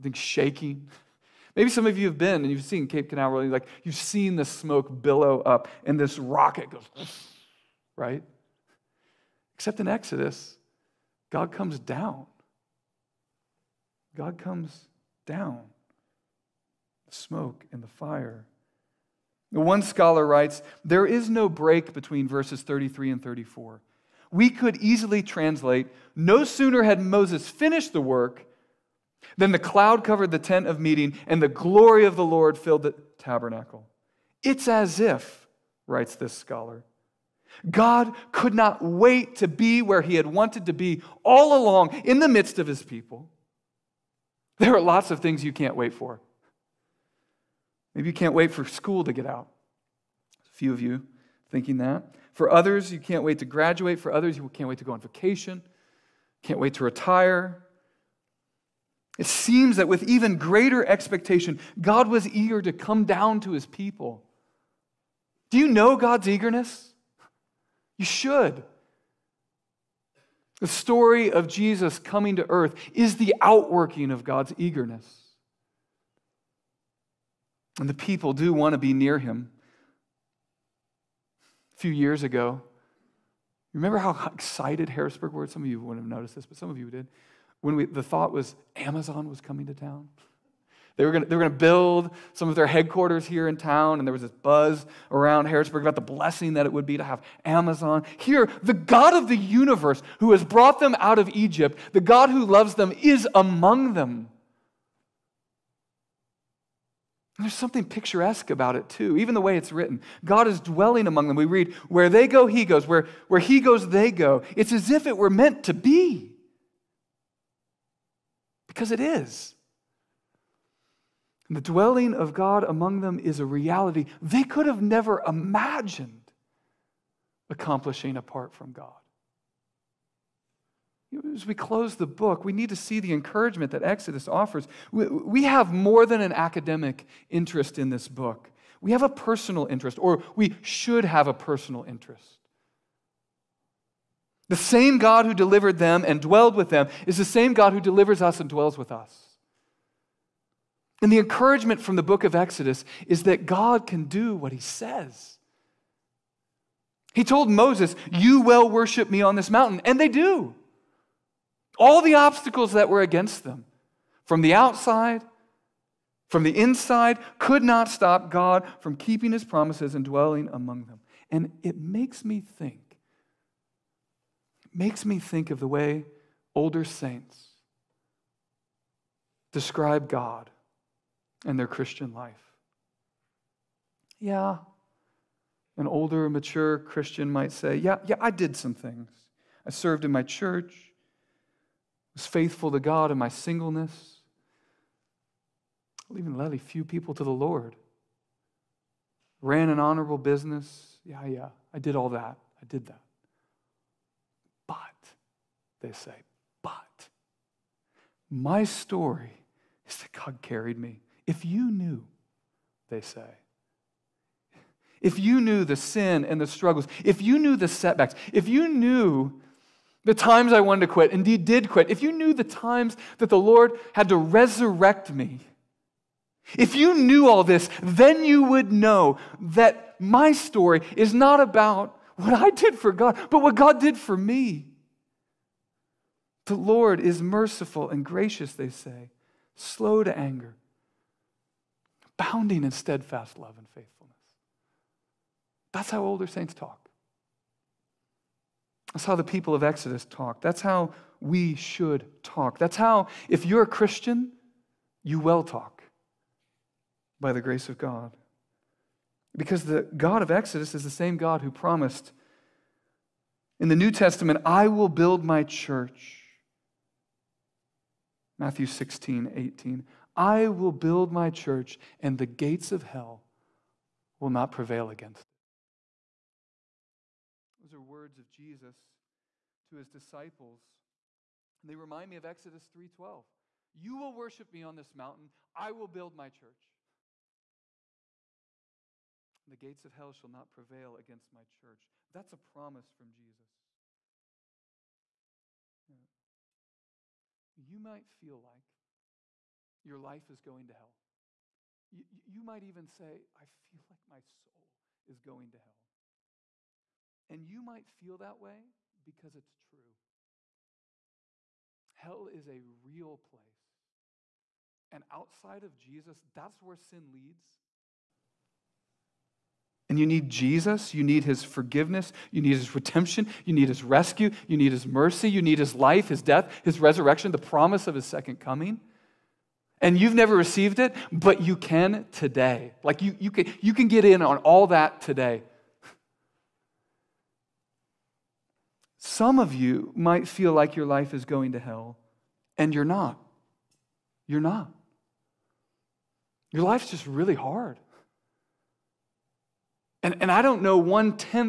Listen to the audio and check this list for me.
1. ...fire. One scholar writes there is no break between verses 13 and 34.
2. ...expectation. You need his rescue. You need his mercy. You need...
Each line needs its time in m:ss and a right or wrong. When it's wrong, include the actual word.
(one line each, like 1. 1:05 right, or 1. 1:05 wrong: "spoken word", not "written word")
1. 0:17 wrong: "33", not "13"
2. 5:22 wrong: "redemption", not "expectation".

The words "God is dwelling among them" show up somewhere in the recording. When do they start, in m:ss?
1:50.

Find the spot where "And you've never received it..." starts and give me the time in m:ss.
5:29.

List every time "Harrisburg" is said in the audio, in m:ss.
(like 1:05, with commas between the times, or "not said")
1:24, 1:35.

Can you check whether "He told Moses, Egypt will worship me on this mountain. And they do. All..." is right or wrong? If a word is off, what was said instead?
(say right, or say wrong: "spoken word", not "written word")
wrong: "You", not "Egypt".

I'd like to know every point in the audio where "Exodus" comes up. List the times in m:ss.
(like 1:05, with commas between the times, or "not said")
0:09, 2:13, 2:32, 4:09, 4:20, 4:42.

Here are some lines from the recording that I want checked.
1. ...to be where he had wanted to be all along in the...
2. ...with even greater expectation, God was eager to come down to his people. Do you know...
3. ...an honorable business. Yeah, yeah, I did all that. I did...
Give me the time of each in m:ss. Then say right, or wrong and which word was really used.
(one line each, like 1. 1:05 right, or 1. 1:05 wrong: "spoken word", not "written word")
1. 0:39 right
2. 0:59 right
3. 3:19 right.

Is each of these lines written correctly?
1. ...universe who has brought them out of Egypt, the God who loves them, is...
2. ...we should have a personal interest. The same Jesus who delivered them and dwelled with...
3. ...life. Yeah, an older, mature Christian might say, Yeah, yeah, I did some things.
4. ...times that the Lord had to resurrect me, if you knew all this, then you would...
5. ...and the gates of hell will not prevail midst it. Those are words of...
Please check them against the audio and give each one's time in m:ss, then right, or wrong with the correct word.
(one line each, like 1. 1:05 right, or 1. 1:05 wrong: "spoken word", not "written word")
1. 1:39 right
2. 2:20 wrong: "God", not "Jesus"
3. 3:02 right
4. 3:42 right
5. 4:32 wrong: "against", not "midst".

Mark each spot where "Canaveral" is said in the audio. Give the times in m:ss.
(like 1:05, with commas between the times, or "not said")
0:03.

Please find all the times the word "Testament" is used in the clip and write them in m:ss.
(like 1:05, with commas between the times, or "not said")
4:23.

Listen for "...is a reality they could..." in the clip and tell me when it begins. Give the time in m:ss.
2:03.